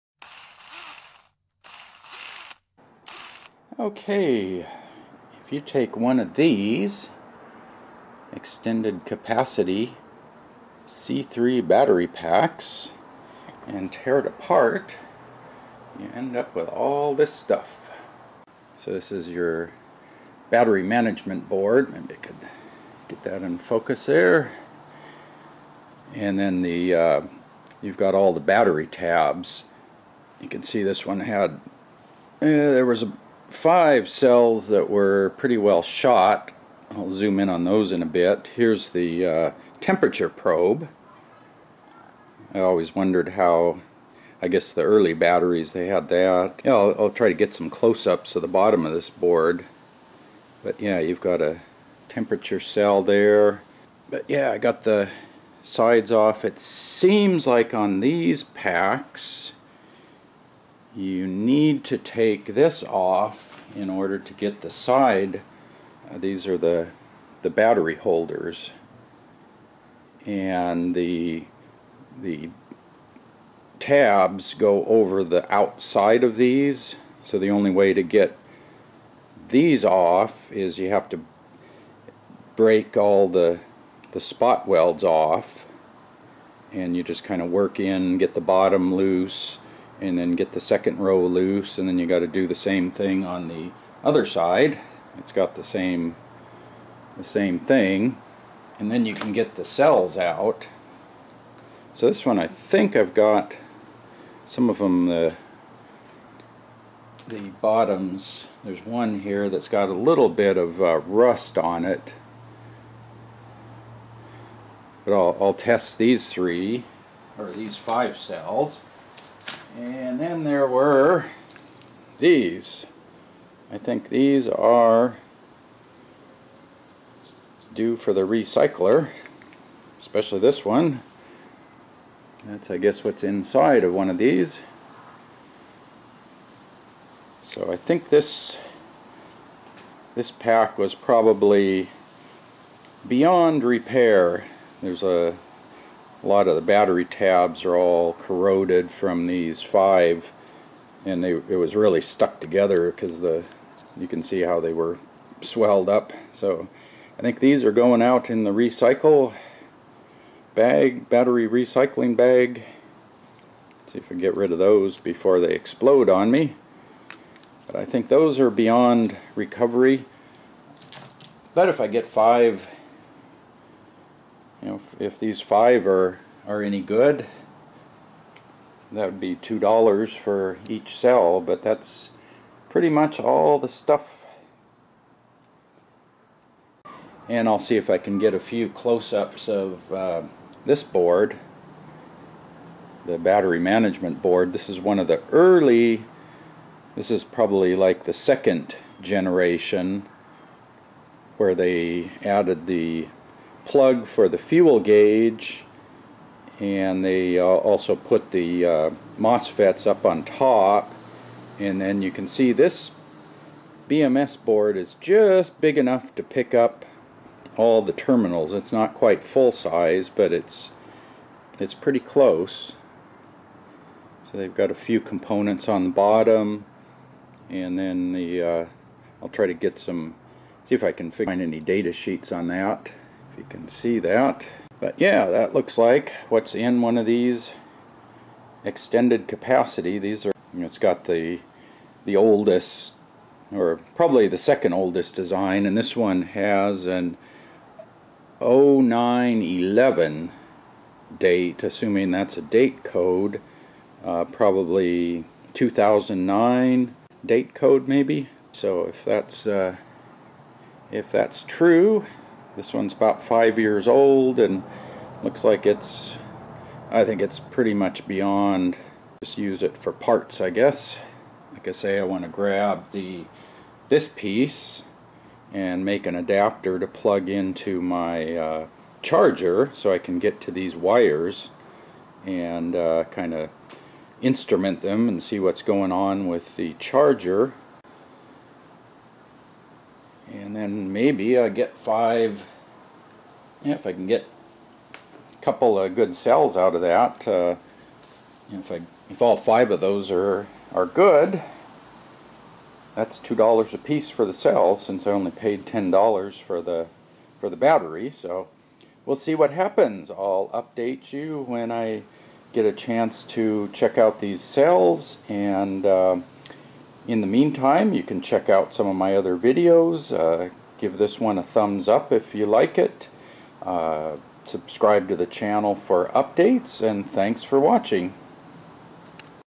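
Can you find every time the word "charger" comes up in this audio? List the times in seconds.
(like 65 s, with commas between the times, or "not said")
279 s, 286 s.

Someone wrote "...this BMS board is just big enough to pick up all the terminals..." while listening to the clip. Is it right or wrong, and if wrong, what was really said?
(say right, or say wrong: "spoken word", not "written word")
right.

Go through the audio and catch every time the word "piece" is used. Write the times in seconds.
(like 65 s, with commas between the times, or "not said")
274 s, 303 s.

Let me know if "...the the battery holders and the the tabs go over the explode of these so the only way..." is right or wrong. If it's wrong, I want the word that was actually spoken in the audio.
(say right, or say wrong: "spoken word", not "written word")
wrong: "outside", not "explode".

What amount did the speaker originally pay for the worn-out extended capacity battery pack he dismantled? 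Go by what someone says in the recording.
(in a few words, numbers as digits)
$10.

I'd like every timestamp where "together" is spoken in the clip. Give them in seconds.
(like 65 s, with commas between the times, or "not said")
152 s.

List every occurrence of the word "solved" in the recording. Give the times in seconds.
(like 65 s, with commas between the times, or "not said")
not said.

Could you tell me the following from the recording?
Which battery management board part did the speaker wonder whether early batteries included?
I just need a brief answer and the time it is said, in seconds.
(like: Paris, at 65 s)
Temperature probe, at 39 s.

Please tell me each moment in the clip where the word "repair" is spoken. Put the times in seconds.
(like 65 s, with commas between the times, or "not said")
143 s.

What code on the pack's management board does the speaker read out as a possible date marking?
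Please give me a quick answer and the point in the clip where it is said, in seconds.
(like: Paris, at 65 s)
0911, at 248 s.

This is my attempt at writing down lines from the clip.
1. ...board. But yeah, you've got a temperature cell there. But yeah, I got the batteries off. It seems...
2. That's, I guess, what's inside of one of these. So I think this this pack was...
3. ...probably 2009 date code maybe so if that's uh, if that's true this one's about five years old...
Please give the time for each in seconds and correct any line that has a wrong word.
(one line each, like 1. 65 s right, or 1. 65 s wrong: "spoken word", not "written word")
1. 49 s wrong: "sides", not "batteries"
2. 132 s right
3. 254 s right.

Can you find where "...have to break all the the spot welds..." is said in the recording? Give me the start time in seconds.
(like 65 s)
80 s.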